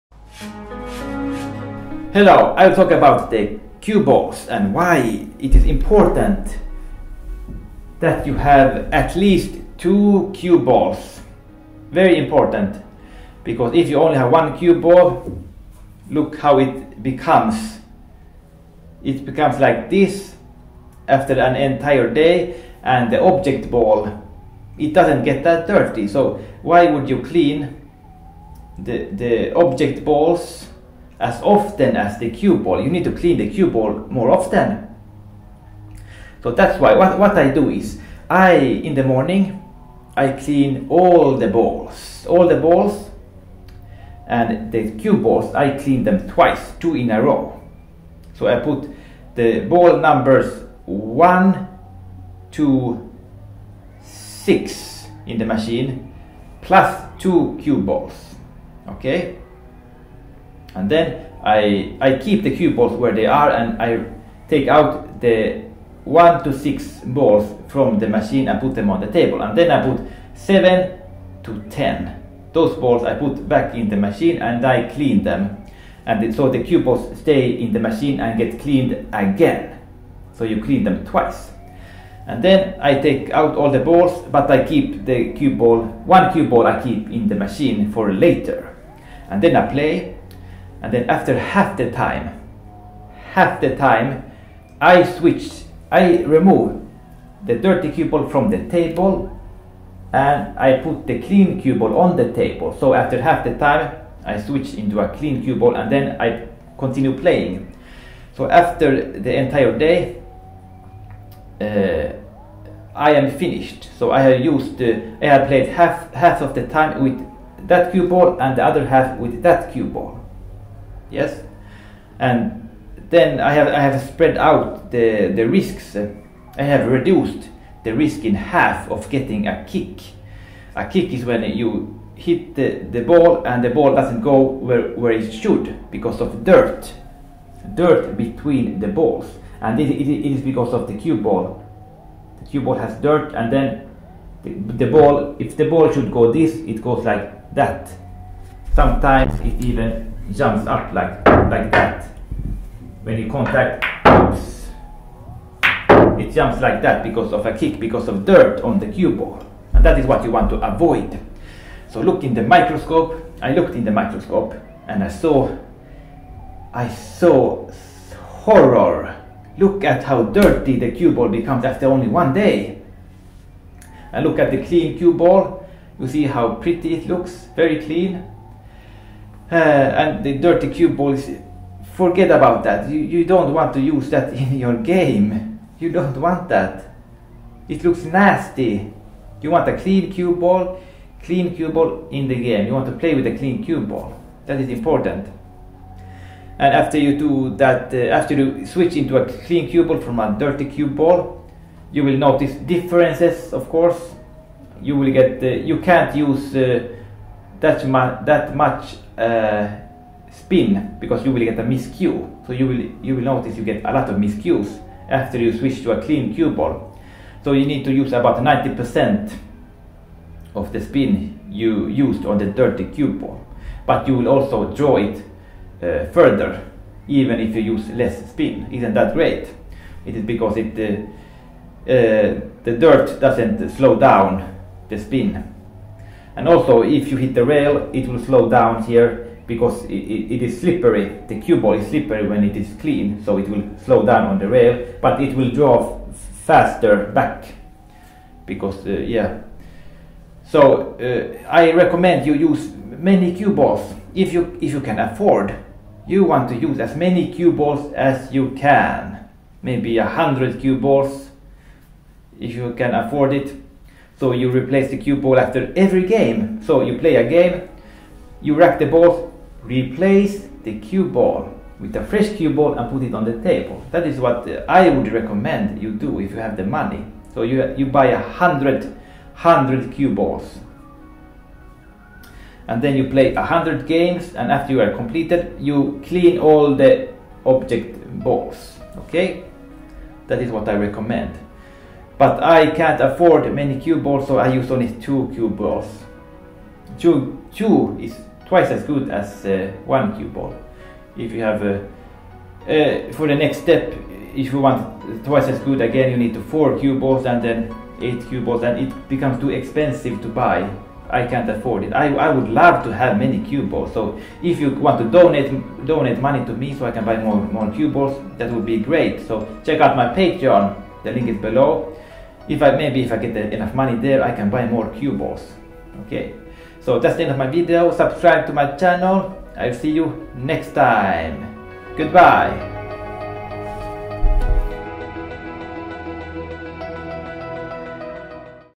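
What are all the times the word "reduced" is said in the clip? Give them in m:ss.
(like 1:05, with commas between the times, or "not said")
2:06.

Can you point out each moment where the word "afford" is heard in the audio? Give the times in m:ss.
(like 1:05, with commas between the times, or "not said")
4:14, 4:22, 4:53, 5:11.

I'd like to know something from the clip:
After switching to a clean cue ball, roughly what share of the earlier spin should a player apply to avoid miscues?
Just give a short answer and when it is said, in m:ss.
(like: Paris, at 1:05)
90%, at 3:38.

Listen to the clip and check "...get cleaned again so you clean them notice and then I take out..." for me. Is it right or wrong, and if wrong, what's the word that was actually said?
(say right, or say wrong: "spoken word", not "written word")
wrong: "twice", not "notice".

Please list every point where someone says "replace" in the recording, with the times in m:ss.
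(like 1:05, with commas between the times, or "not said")
4:24, 4:29.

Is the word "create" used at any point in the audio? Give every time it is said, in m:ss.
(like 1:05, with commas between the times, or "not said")
not said.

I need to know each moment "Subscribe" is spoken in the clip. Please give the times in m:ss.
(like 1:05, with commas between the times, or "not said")
5:27.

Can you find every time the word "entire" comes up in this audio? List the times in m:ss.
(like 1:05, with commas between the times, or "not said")
0:21, 1:49.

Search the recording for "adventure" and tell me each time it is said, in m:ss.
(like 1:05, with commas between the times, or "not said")
not said.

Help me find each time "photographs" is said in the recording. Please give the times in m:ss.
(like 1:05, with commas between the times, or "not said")
not said.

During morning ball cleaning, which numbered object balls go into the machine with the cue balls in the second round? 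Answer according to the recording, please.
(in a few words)
7 to 10.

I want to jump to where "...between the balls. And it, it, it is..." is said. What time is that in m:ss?
2:18.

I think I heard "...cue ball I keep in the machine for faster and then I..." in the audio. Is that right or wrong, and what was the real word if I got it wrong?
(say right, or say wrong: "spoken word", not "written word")
wrong: "later", not "faster".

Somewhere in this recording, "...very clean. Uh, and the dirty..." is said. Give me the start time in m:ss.
2:57.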